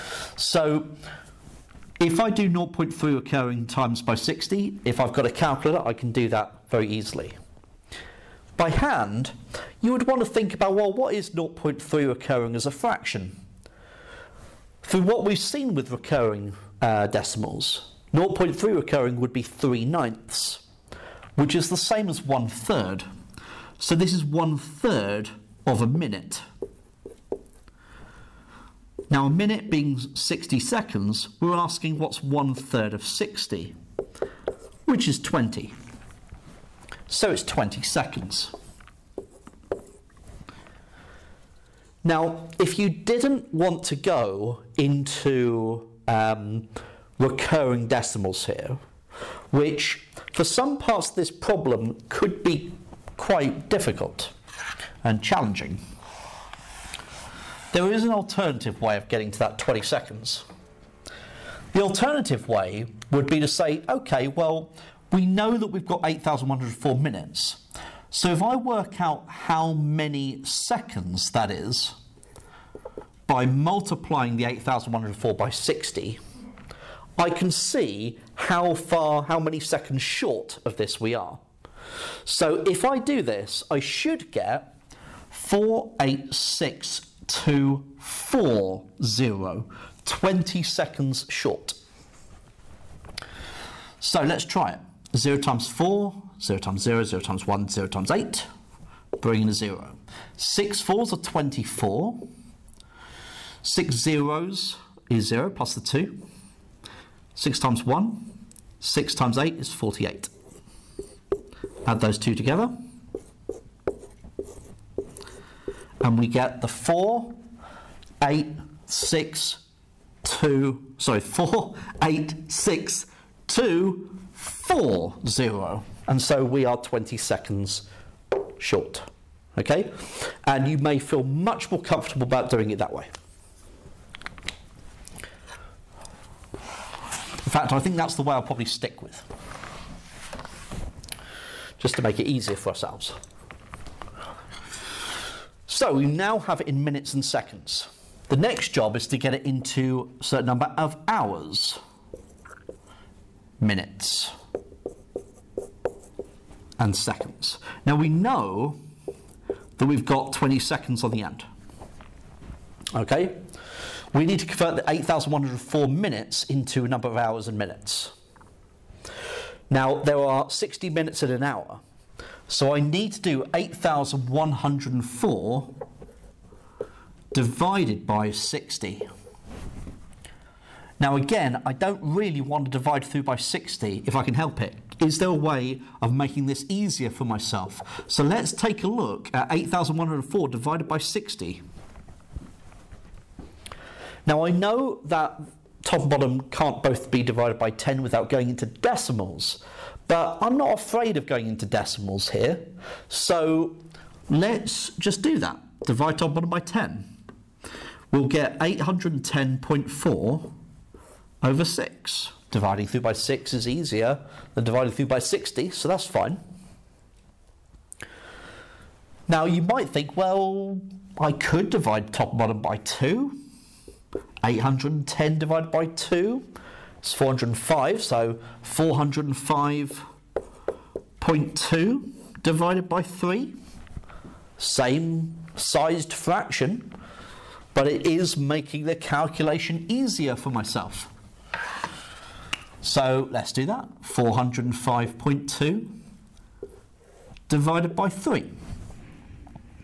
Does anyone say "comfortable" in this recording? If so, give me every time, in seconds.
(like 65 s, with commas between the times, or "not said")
131 s.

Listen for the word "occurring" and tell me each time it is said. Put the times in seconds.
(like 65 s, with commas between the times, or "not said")
3 s, 12 s.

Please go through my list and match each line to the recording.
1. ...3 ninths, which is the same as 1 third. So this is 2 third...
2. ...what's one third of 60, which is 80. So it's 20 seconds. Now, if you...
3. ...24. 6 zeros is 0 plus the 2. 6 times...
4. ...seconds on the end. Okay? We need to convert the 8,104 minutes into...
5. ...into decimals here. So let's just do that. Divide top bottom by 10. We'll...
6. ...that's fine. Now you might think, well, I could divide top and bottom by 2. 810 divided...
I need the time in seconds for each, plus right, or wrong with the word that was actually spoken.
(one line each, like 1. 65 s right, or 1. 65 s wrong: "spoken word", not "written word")
1. 19 s wrong: "1", not "2"
2. 31 s wrong: "20", not "80"
3. 101 s right
4. 160 s right
5. 201 s right
6. 215 s right.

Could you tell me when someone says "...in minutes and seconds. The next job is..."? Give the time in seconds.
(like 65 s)
146 s.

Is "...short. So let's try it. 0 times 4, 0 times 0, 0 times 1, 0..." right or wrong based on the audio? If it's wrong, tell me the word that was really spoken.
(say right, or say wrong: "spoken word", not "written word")
right.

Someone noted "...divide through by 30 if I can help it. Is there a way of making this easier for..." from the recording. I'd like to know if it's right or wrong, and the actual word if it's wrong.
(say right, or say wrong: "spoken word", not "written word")
wrong: "60", not "30".